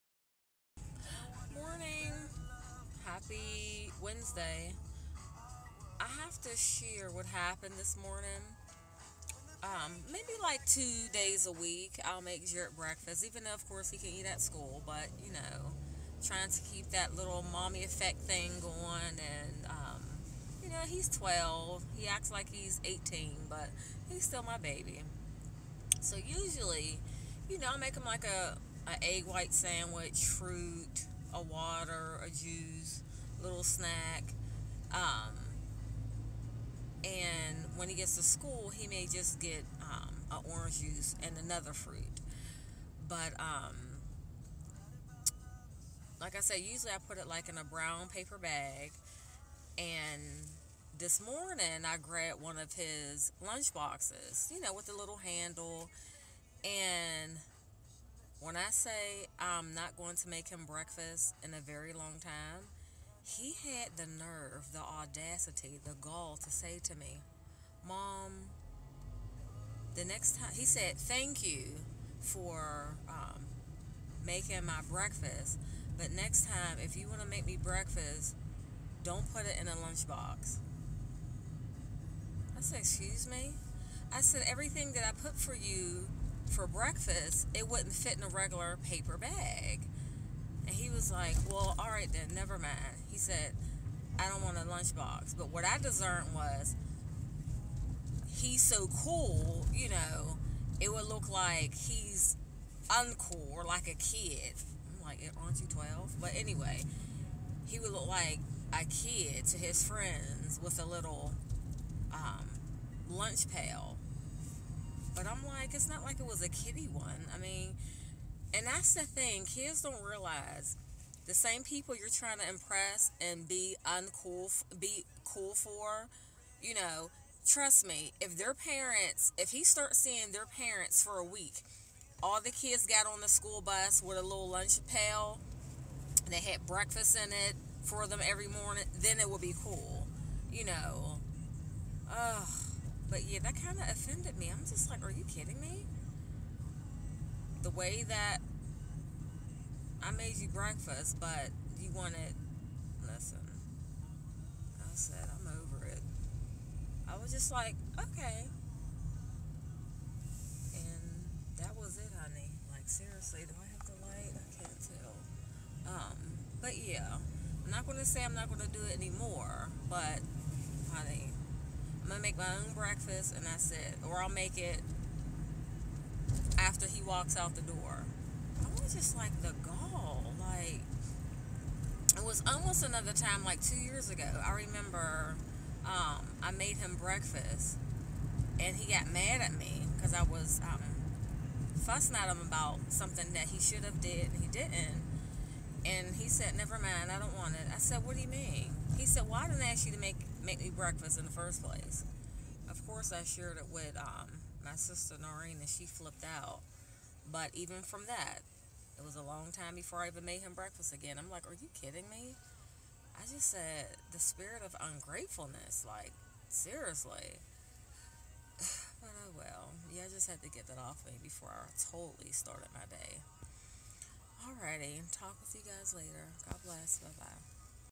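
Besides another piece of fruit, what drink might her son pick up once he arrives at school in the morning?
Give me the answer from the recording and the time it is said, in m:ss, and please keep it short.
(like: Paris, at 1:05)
orange juice, at 0:40.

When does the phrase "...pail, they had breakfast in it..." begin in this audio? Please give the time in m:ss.
2:14.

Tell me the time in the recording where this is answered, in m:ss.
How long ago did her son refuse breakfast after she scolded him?
3:03.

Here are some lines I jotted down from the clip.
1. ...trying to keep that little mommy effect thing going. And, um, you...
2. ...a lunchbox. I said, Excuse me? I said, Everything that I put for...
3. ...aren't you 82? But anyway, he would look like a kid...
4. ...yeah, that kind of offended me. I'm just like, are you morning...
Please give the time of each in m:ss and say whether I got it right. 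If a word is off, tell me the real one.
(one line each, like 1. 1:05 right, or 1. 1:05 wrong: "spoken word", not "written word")
1. 0:16 right
2. 1:19 right
3. 1:45 wrong: "12", not "82"
4. 2:23 wrong: "kidding", not "morning".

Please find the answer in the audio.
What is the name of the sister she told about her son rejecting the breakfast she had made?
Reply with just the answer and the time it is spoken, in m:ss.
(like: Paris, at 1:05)
Noreen, at 3:25.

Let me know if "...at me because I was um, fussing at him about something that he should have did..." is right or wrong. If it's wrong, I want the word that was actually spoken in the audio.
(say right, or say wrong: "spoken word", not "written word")
right.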